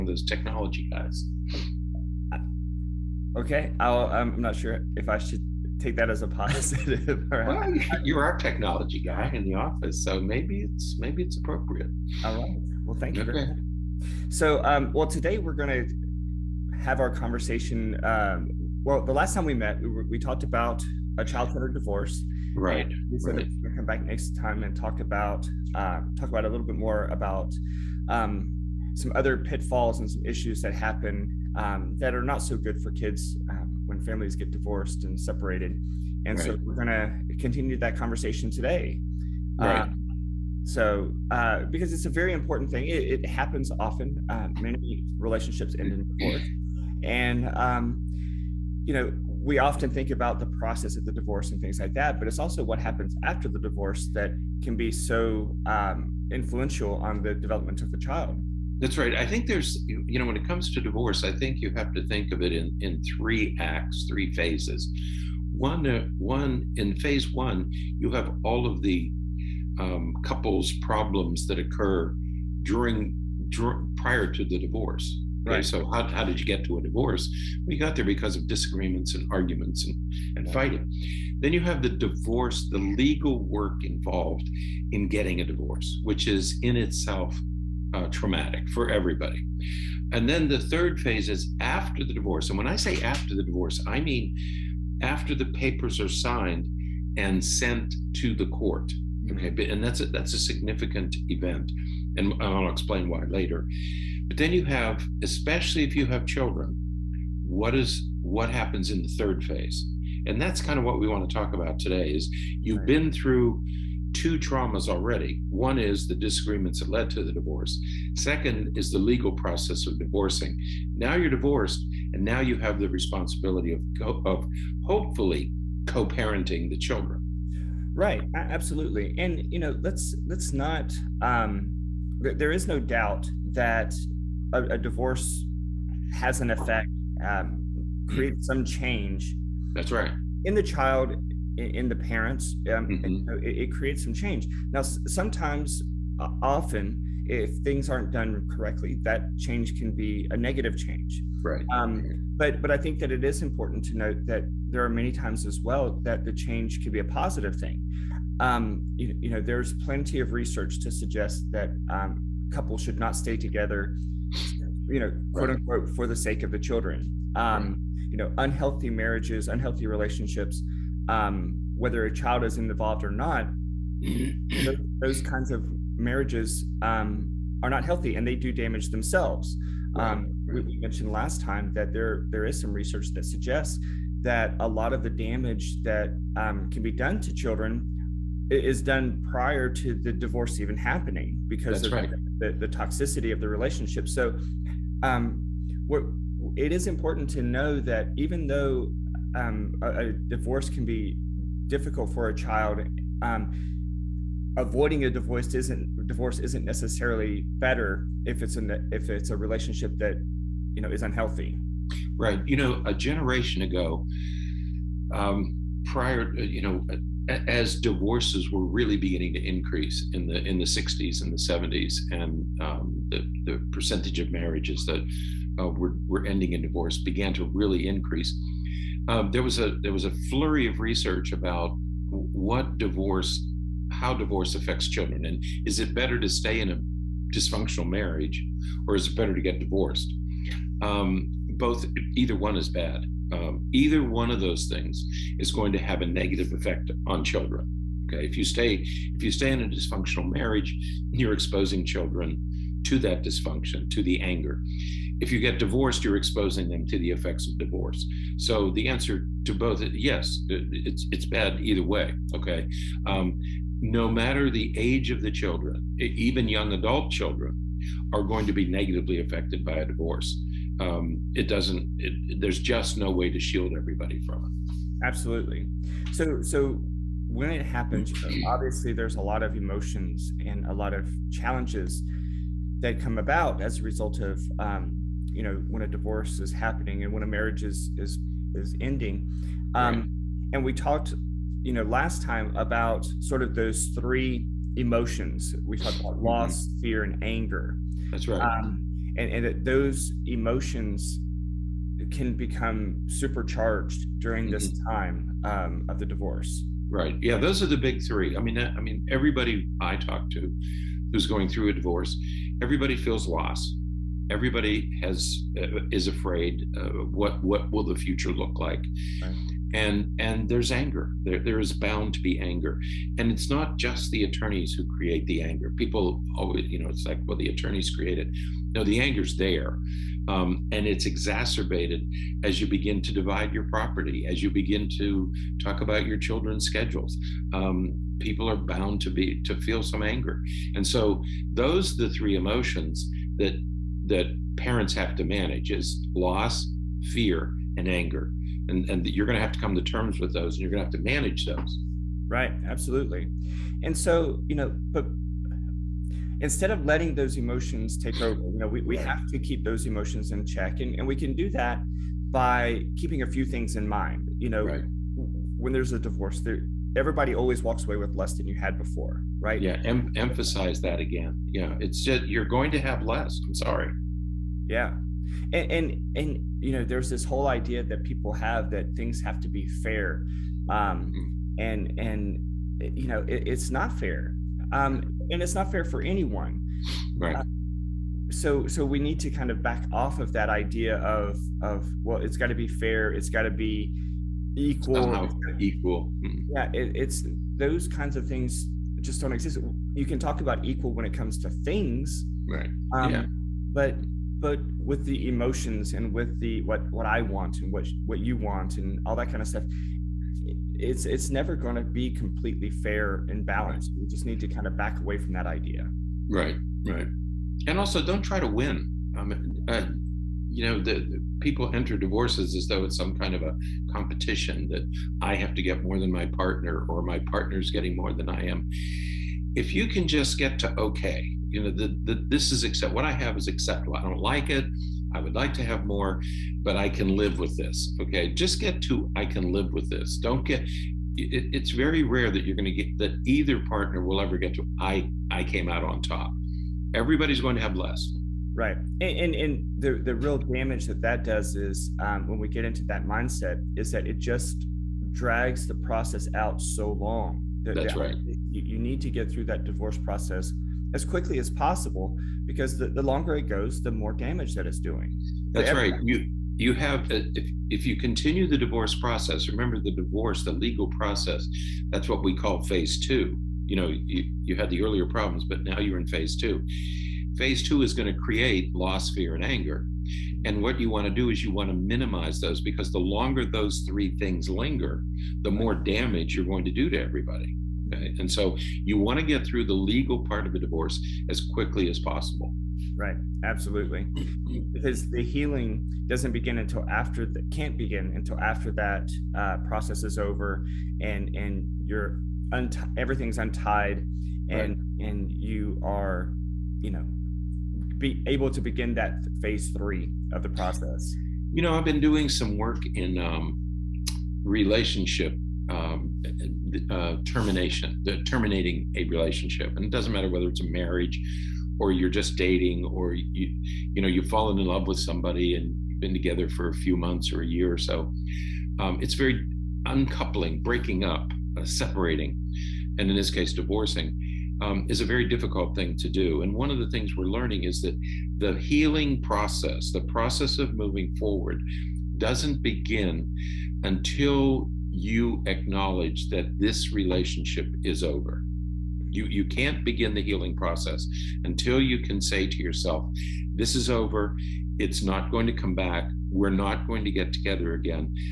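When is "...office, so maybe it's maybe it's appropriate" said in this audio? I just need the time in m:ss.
0:09.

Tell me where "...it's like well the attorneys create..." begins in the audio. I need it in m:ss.
5:26.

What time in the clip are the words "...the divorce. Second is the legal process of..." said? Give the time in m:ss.
1:57.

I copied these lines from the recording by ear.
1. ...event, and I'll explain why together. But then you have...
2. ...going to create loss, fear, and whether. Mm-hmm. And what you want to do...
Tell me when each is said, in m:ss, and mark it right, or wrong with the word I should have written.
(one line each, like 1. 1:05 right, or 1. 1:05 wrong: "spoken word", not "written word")
1. 1:41 wrong: "later", not "together"
2. 7:57 wrong: "anger", not "whether".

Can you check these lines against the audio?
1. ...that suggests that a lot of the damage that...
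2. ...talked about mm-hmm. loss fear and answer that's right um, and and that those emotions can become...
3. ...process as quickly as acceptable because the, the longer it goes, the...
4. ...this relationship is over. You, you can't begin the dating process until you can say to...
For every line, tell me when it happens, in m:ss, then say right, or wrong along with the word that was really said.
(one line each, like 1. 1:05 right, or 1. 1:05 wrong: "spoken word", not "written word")
1. 3:03 right
2. 4:55 wrong: "anger", not "answer"
3. 7:39 wrong: "possible", not "acceptable"
4. 9:06 wrong: "healing", not "dating".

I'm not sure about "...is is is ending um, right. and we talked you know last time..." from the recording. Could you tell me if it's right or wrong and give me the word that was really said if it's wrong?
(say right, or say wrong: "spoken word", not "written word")
right.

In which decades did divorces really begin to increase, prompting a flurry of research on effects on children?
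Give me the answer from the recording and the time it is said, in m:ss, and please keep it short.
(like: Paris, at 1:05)
60s and 70s, at 3:40.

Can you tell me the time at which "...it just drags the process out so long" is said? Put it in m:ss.
7:34.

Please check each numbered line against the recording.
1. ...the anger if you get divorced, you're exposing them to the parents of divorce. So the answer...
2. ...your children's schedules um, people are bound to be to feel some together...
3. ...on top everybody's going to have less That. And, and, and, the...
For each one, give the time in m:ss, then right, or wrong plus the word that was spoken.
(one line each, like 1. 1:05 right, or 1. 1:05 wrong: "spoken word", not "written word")
1. 4:14 wrong: "effects", not "parents"
2. 5:36 wrong: "anger", not "together"
3. 7:25 wrong: "Right", not "That".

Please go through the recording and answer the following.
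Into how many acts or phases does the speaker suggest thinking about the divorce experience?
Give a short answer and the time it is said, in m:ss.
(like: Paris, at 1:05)
3, at 1:03.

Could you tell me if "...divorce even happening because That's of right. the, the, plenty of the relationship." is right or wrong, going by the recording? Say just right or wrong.
wrong.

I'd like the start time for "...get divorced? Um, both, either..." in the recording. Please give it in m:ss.
3:59.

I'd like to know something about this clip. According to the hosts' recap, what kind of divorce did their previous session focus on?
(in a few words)
child-centered divorce.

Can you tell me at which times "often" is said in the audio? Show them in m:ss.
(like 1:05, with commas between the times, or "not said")
0:43, 0:49, 2:26.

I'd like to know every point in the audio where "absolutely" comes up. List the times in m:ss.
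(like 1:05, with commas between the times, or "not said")
2:08, 4:35, 5:52, 8:13.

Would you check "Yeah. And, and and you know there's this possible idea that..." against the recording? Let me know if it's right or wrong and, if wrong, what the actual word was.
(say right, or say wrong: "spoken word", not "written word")
wrong: "whole", not "possible".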